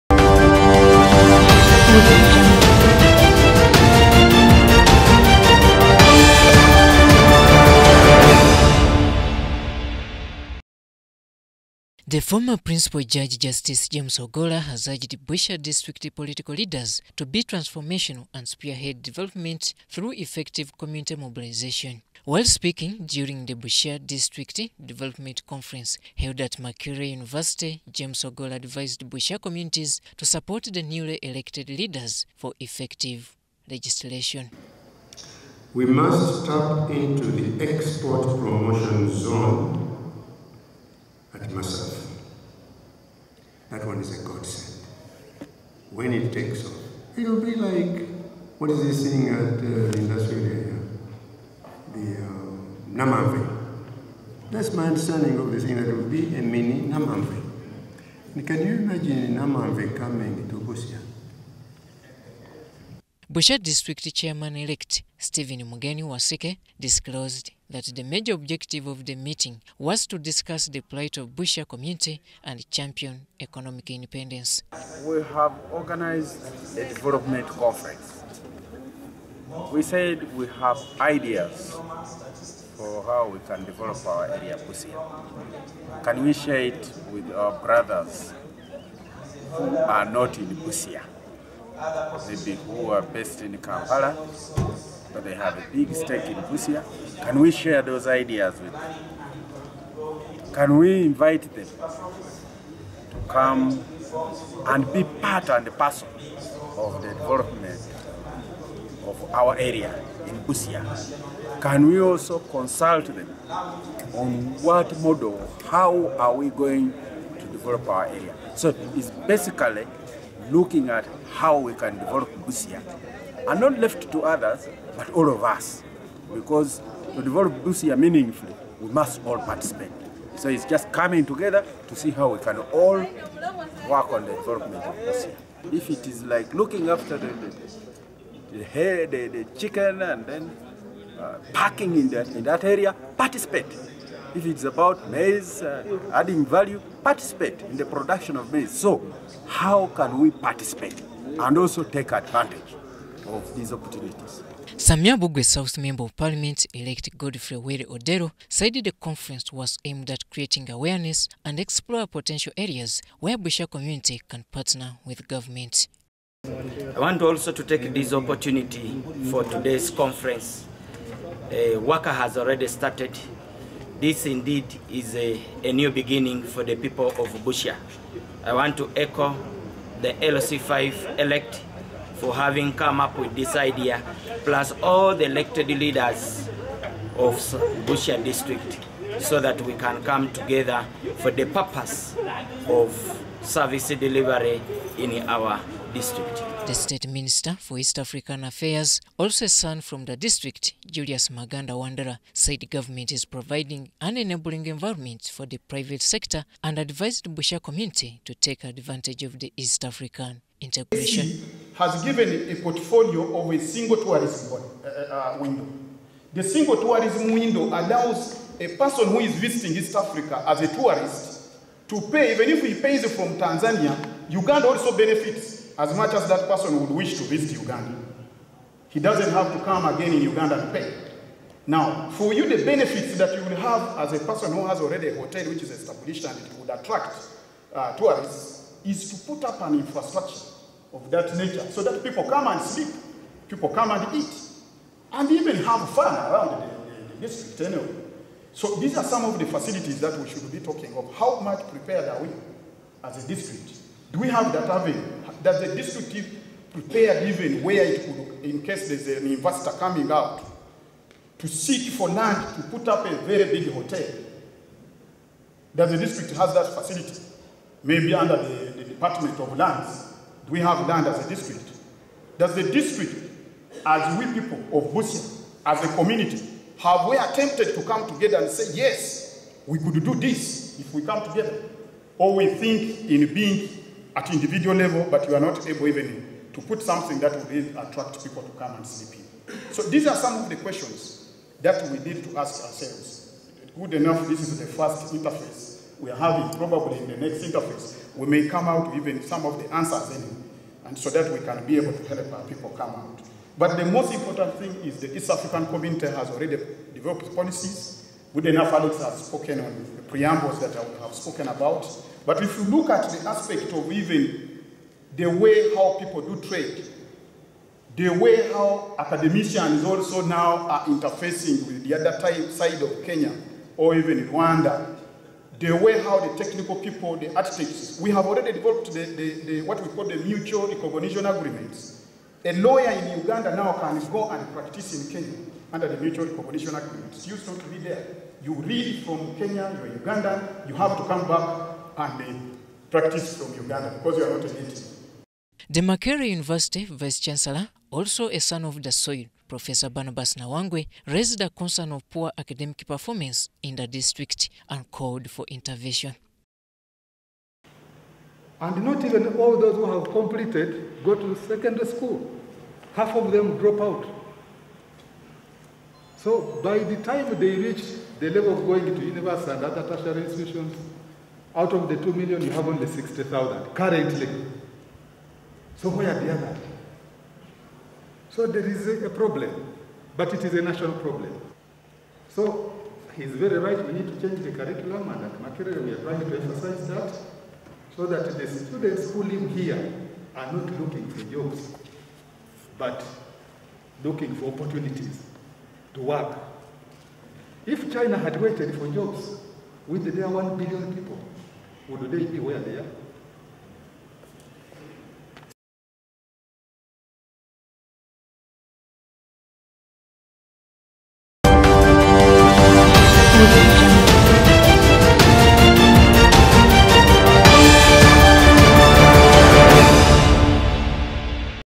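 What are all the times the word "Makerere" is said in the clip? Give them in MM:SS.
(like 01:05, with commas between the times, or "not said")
00:26, 05:45, 06:25.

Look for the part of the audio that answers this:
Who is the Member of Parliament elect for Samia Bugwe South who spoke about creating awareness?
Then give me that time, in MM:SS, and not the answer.
02:37.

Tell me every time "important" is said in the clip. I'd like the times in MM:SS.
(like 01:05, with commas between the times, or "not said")
05:04.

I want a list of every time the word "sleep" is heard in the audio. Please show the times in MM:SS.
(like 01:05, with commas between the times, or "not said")
04:02, 04:48.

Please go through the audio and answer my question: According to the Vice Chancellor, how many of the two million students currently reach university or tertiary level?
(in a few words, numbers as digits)
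60,000.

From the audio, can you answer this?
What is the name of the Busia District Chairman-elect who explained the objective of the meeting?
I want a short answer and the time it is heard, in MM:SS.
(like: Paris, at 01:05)
Stephen Mugeni Wasike, at 01:05.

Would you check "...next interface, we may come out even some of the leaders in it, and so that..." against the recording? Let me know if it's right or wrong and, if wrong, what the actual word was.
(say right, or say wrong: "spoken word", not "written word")
wrong: "answers", not "leaders".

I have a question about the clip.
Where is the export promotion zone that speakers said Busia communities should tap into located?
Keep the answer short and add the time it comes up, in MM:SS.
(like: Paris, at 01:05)
Masaka, at 00:41.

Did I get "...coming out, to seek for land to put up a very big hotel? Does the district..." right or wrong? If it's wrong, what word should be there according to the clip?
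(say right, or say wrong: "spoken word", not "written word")
right.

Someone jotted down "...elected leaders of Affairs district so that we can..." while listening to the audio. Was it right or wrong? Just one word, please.
wrong.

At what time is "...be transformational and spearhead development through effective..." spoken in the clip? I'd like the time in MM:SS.
00:17.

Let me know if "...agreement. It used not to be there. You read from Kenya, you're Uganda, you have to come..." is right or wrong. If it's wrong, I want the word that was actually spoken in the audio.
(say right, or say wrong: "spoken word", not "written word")
right.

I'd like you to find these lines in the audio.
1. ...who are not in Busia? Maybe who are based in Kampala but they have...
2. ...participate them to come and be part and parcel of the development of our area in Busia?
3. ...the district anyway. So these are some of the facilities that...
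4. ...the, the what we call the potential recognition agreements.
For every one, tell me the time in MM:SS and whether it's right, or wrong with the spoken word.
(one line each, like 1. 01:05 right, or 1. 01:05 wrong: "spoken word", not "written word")
1. 01:29 right
2. 01:41 wrong: "invite", not "participate"
3. 04:07 right
4. 05:29 wrong: "mutual", not "potential".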